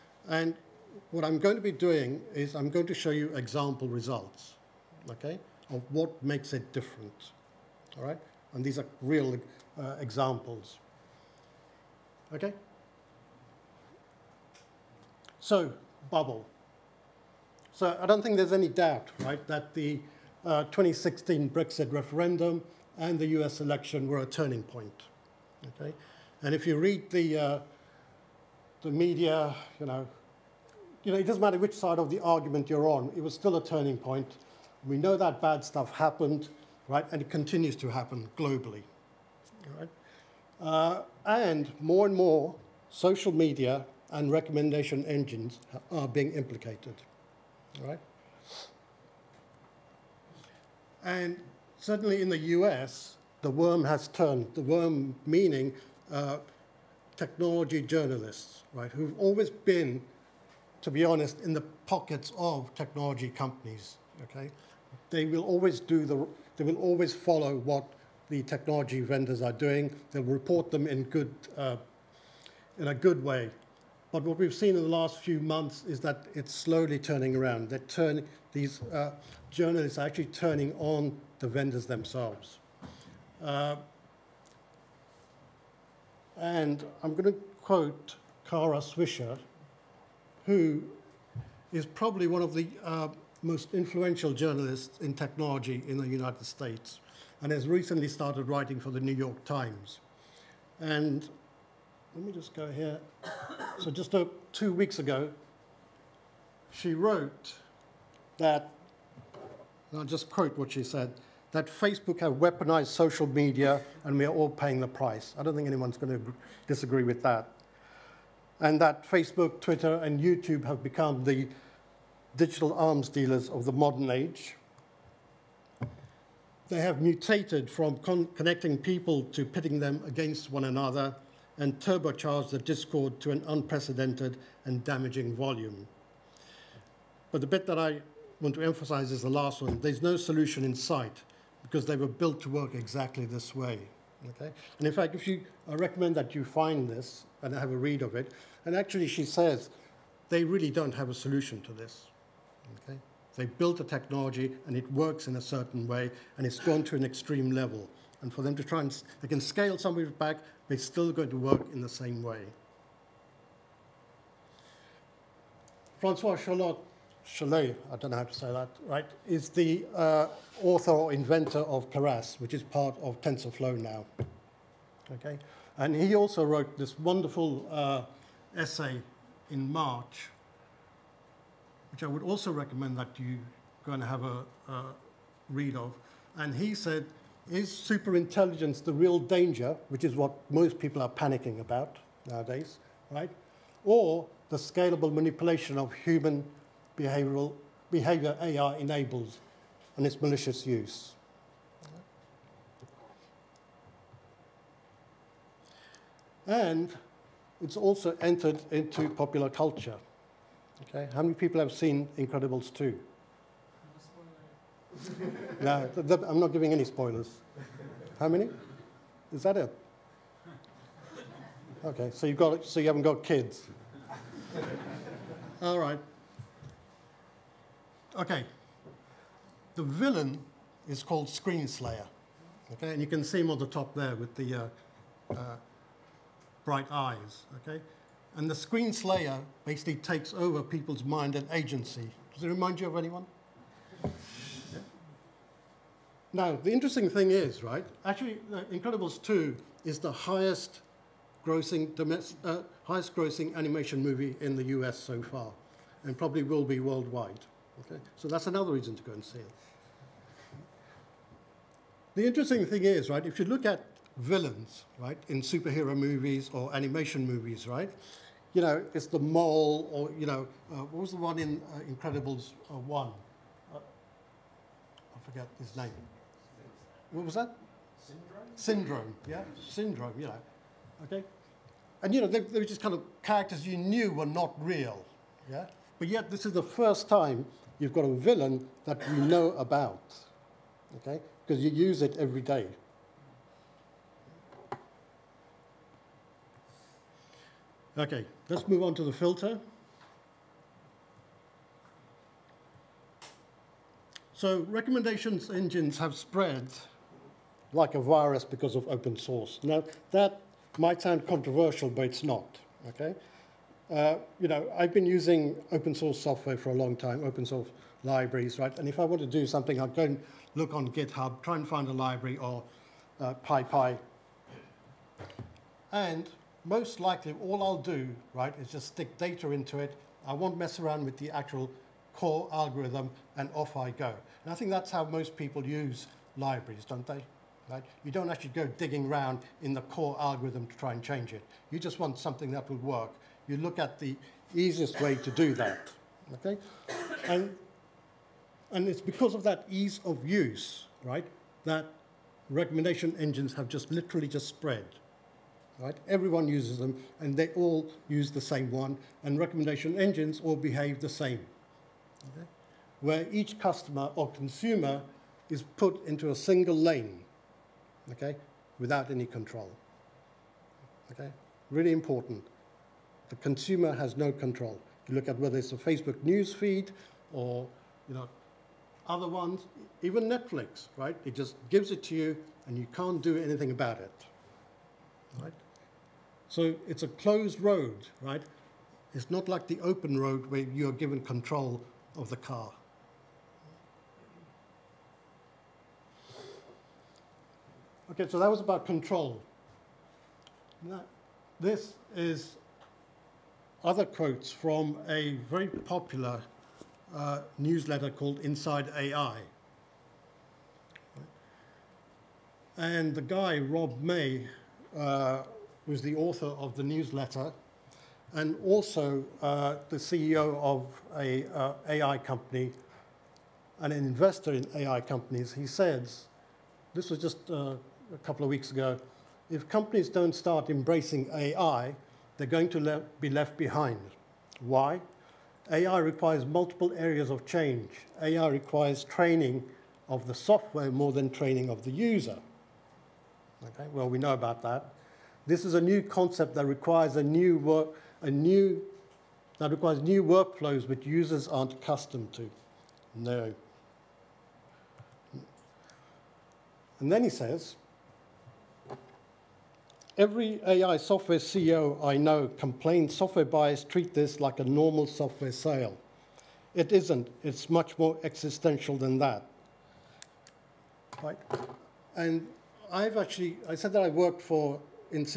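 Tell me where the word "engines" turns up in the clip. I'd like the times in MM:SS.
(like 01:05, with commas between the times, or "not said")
00:45, 05:05, 05:53, 05:59.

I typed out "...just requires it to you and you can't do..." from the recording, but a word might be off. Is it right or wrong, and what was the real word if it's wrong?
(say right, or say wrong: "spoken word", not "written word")
wrong: "gives", not "requires".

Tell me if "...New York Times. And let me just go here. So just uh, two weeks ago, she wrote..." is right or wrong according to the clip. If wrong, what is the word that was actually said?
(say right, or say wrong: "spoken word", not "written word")
right.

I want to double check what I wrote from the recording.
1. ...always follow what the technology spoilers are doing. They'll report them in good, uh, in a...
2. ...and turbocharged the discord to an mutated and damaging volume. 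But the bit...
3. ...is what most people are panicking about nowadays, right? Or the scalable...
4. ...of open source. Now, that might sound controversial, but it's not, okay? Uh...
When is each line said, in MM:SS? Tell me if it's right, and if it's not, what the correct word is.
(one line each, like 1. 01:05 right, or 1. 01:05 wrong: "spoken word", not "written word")
1. 01:06 wrong: "vendors", not "spoilers"
2. 02:11 wrong: "unprecedented", not "mutated"
3. 03:10 right
4. 05:08 right.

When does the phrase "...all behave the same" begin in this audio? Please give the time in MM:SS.
06:00.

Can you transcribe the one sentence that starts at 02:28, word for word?
And actually, she says they really don't have a solution to this.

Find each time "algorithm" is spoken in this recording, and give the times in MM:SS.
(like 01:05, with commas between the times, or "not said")
05:32, 05:40.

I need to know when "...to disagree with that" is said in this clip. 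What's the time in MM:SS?
01:56.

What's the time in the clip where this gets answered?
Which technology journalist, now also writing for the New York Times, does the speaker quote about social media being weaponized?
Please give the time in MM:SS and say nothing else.
01:28.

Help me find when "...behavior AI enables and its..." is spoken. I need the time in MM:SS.
03:17.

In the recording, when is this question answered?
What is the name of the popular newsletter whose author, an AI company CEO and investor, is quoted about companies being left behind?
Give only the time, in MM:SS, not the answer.
06:48.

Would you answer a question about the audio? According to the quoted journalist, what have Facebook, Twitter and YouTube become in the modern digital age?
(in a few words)
arms dealers.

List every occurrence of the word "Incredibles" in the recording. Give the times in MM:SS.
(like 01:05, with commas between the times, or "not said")
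03:32, 04:08, 04:31.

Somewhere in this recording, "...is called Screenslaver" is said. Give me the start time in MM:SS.
03:50.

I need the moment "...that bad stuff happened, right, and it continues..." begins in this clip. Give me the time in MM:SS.
00:35.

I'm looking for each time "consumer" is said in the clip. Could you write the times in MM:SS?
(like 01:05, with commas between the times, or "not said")
06:04, 06:13.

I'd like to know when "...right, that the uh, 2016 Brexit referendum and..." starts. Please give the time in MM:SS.
00:19.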